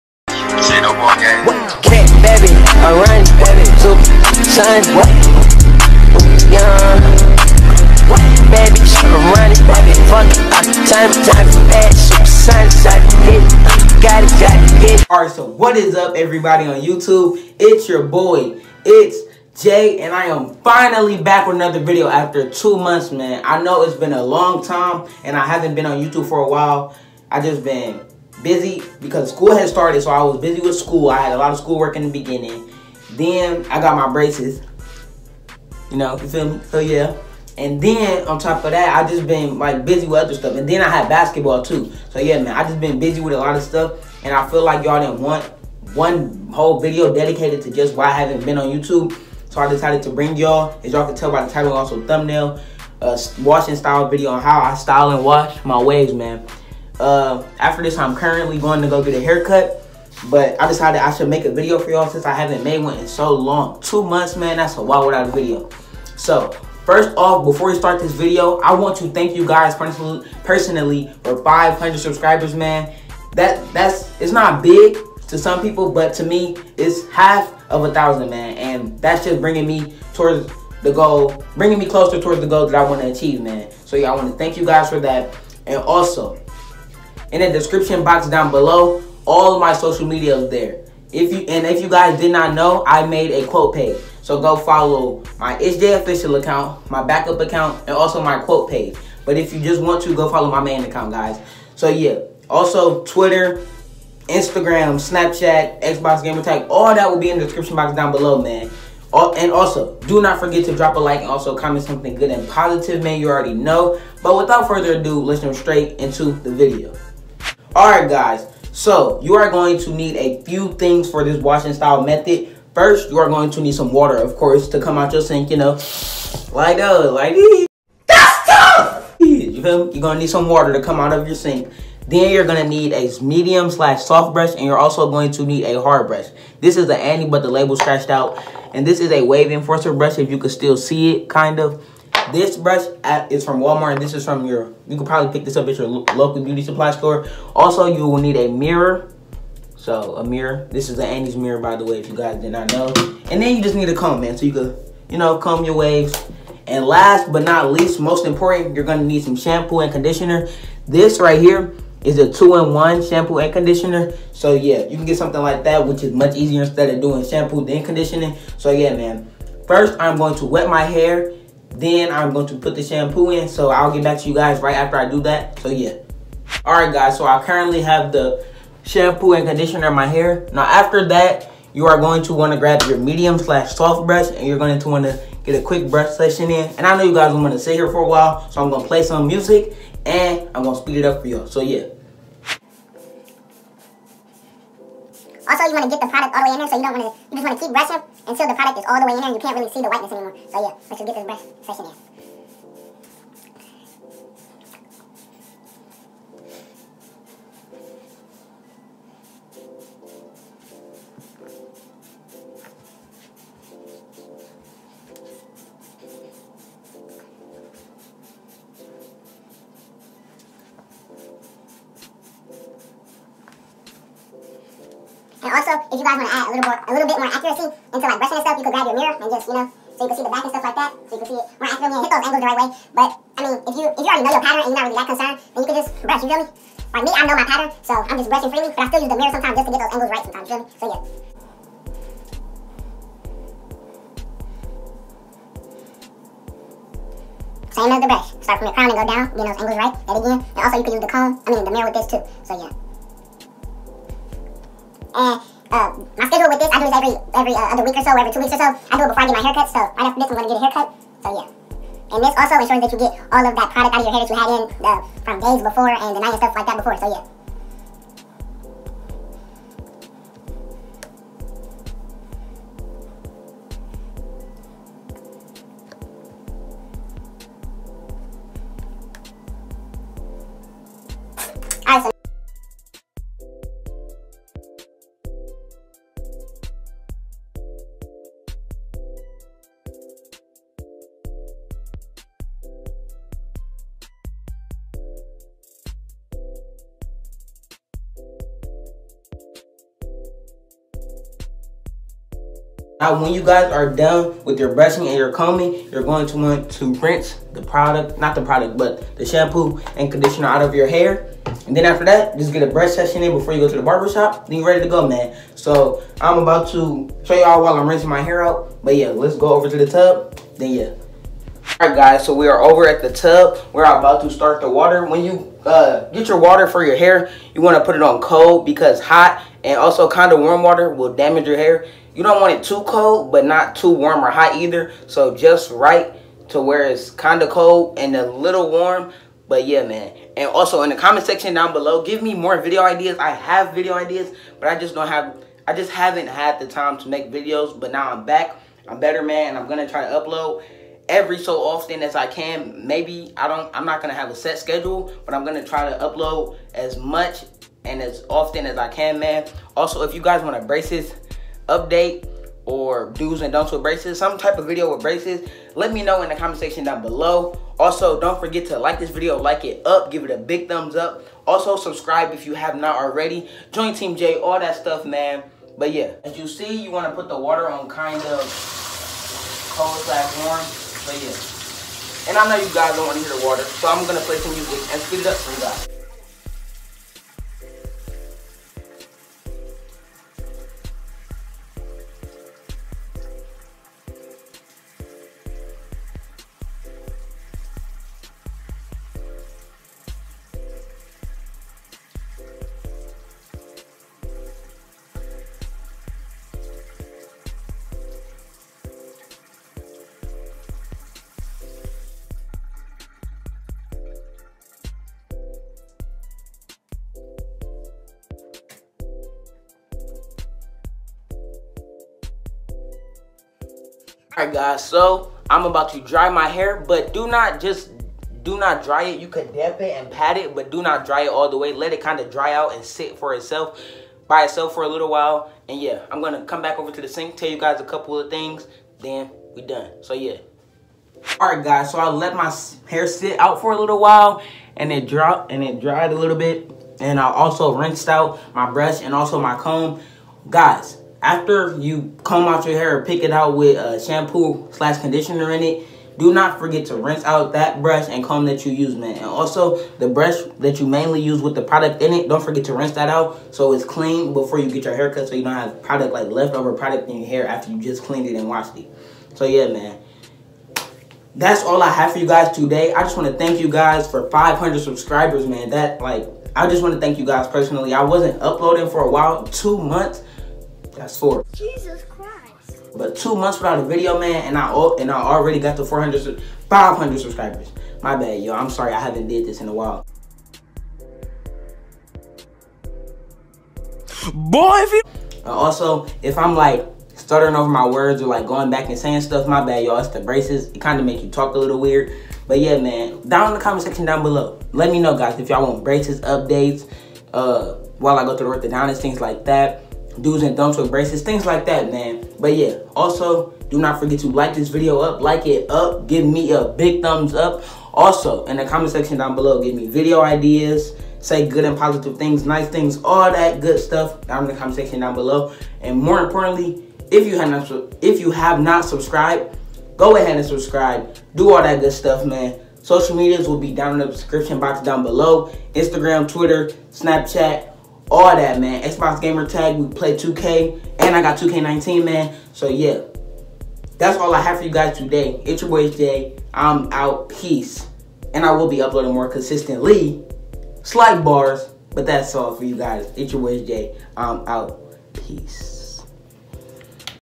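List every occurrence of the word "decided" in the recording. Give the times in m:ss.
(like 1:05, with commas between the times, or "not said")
0:49, 1:00.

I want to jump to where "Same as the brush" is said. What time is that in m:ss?
4:07.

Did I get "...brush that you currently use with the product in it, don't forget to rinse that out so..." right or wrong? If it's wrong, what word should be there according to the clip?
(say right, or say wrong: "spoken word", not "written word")
wrong: "mainly", not "currently".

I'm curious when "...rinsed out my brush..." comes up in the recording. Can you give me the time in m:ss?
7:27.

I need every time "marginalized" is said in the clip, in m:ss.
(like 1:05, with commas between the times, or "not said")
not said.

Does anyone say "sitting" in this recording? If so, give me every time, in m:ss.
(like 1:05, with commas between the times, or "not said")
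not said.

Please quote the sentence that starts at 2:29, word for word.
So a mirror, this is the Annie's mirror by the way, if you guys did not know.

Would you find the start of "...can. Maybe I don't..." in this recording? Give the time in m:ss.
5:52.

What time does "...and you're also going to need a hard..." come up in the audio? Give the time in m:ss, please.
2:14.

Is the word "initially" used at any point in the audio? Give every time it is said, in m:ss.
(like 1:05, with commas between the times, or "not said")
not said.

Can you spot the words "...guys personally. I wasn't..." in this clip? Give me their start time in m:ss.
7:57.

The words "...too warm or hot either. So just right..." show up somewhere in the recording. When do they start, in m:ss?
5:33.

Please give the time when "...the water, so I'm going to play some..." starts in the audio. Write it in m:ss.
6:23.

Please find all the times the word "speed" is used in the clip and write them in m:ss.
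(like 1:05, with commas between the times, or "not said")
3:10, 6:25.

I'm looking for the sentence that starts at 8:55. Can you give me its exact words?
Instagram, Twitter, Snapchat, all that, man.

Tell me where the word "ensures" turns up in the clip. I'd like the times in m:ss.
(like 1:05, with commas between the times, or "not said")
4:22.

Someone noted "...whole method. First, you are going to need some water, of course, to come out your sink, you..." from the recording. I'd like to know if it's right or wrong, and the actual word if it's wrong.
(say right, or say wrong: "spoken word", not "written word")
wrong: "style", not "whole".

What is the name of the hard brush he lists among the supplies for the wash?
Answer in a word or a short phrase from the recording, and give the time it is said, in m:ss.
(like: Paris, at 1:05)
wave enforcer, at 2:19.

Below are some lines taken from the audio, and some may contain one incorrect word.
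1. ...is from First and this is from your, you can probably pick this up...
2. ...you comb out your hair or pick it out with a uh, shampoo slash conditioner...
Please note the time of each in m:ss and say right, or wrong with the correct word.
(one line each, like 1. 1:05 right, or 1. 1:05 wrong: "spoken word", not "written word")
1. 2:23 wrong: "Walmart", not "First"
2. 7:31 right.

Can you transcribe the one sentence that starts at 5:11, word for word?
And then after that, just get a brush session in before you go to the barbershop.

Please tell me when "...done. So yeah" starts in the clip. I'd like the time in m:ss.
7:19.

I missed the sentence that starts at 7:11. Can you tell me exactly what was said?
Let it kind of dry out and sit for itself by itself for a little while.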